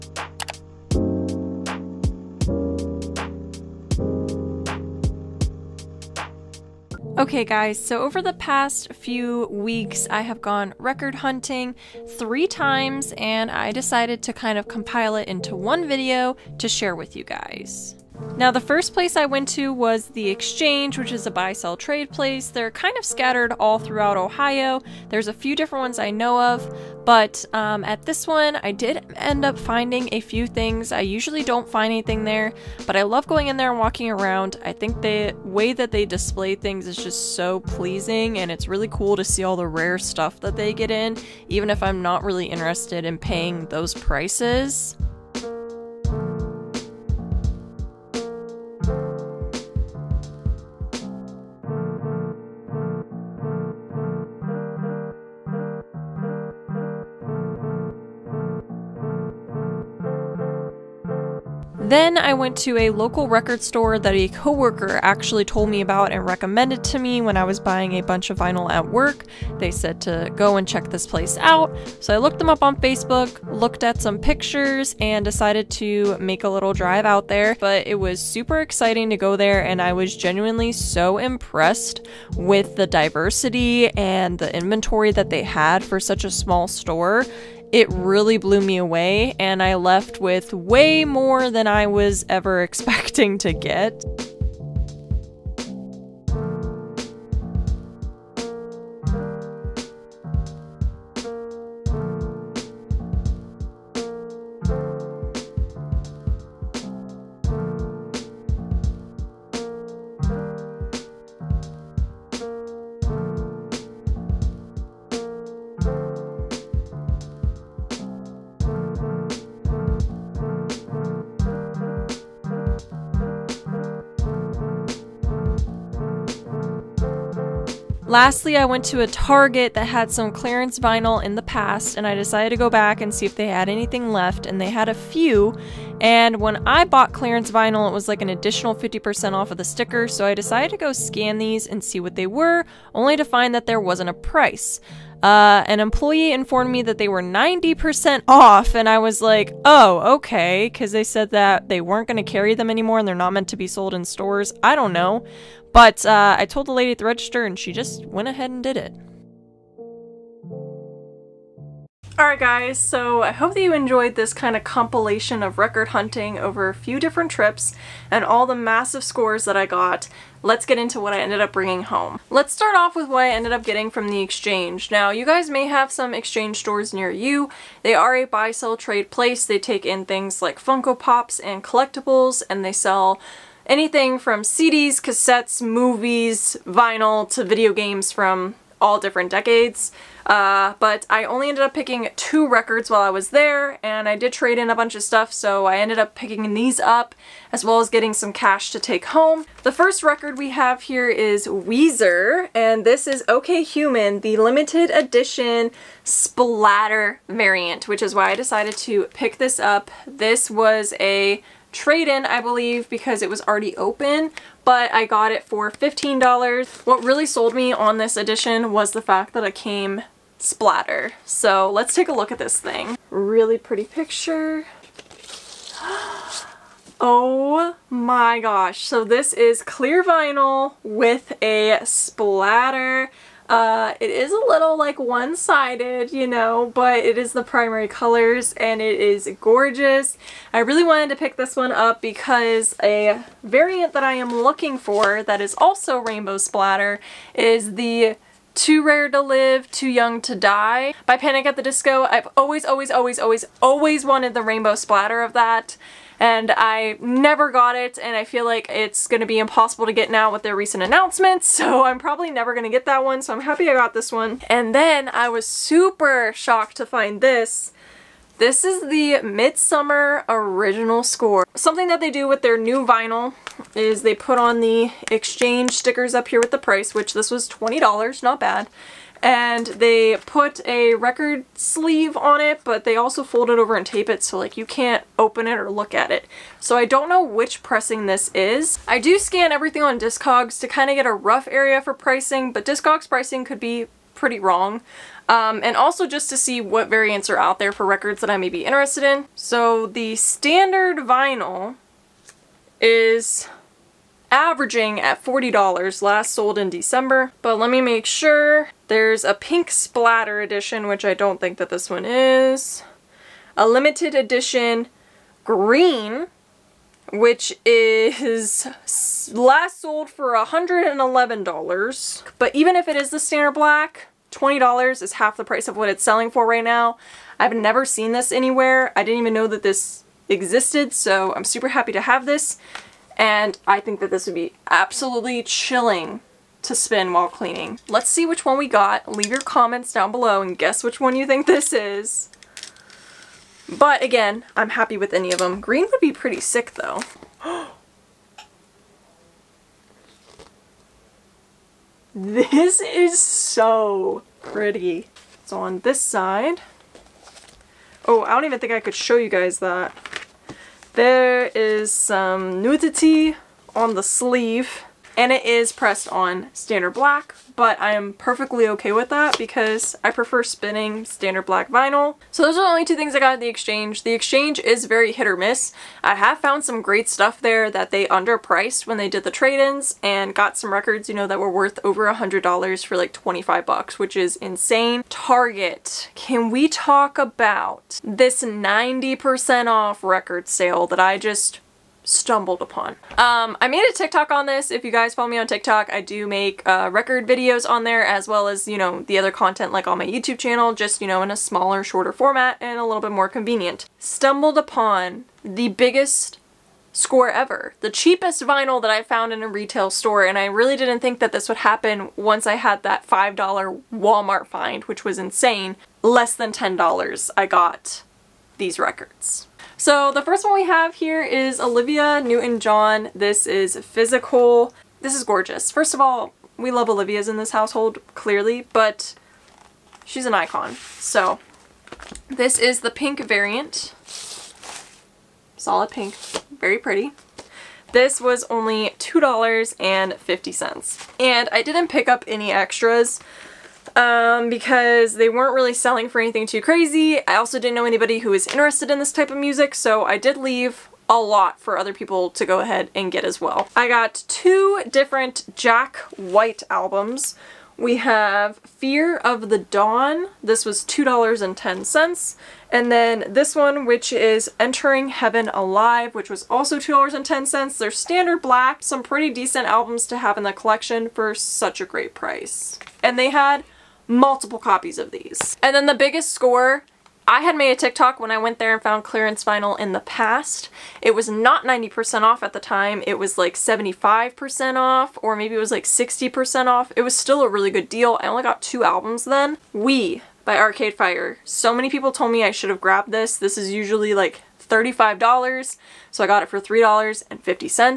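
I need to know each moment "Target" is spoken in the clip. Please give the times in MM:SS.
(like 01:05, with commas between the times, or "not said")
02:09, 06:25.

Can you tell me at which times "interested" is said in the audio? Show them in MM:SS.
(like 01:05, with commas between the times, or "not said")
00:42, 04:58, 07:28.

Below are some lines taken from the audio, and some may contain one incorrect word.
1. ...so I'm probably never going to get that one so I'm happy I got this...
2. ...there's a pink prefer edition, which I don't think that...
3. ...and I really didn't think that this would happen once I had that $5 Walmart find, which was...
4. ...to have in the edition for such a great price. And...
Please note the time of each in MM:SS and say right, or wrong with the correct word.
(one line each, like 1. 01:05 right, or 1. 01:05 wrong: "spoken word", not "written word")
1. 04:21 right
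2. 05:08 wrong: "splatter", not "prefer"
3. 06:50 right
4. 07:50 wrong: "collection", not "edition".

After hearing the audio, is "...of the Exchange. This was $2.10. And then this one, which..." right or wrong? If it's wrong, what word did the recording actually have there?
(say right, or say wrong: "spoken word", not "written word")
wrong: "Dawn", not "Exchange".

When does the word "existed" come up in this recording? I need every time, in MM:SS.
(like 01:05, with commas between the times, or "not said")
05:30.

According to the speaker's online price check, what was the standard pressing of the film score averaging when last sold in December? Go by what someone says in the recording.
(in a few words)
$40.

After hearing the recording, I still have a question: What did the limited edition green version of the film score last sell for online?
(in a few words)
$111.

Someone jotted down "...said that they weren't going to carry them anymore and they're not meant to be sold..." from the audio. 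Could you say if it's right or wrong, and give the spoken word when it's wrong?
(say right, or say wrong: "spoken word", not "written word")
right.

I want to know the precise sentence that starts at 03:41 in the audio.
So let's take a look at this thing.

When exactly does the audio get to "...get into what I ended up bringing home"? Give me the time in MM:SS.
02:50.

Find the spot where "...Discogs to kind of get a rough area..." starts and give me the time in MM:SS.
04:49.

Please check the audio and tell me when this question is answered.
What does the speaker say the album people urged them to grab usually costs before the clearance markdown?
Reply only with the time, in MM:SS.
08:14.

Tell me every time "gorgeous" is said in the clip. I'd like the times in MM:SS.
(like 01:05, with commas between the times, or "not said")
03:59, 07:05.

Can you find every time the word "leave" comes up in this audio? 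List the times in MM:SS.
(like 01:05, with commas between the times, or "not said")
05:39, 07:30.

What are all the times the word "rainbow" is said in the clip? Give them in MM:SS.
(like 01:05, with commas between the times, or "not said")
04:05, 04:14.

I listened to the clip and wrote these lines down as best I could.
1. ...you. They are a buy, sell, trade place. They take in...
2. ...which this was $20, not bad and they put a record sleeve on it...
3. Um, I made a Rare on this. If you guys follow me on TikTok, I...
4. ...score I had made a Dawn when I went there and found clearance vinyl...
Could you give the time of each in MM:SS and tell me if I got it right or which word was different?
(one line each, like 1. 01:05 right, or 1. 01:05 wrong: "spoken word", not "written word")
1. 02:57 right
2. 04:36 right
3. 06:33 wrong: "TikTok", not "Rare"
4. 07:56 wrong: "TikTok", not "Dawn".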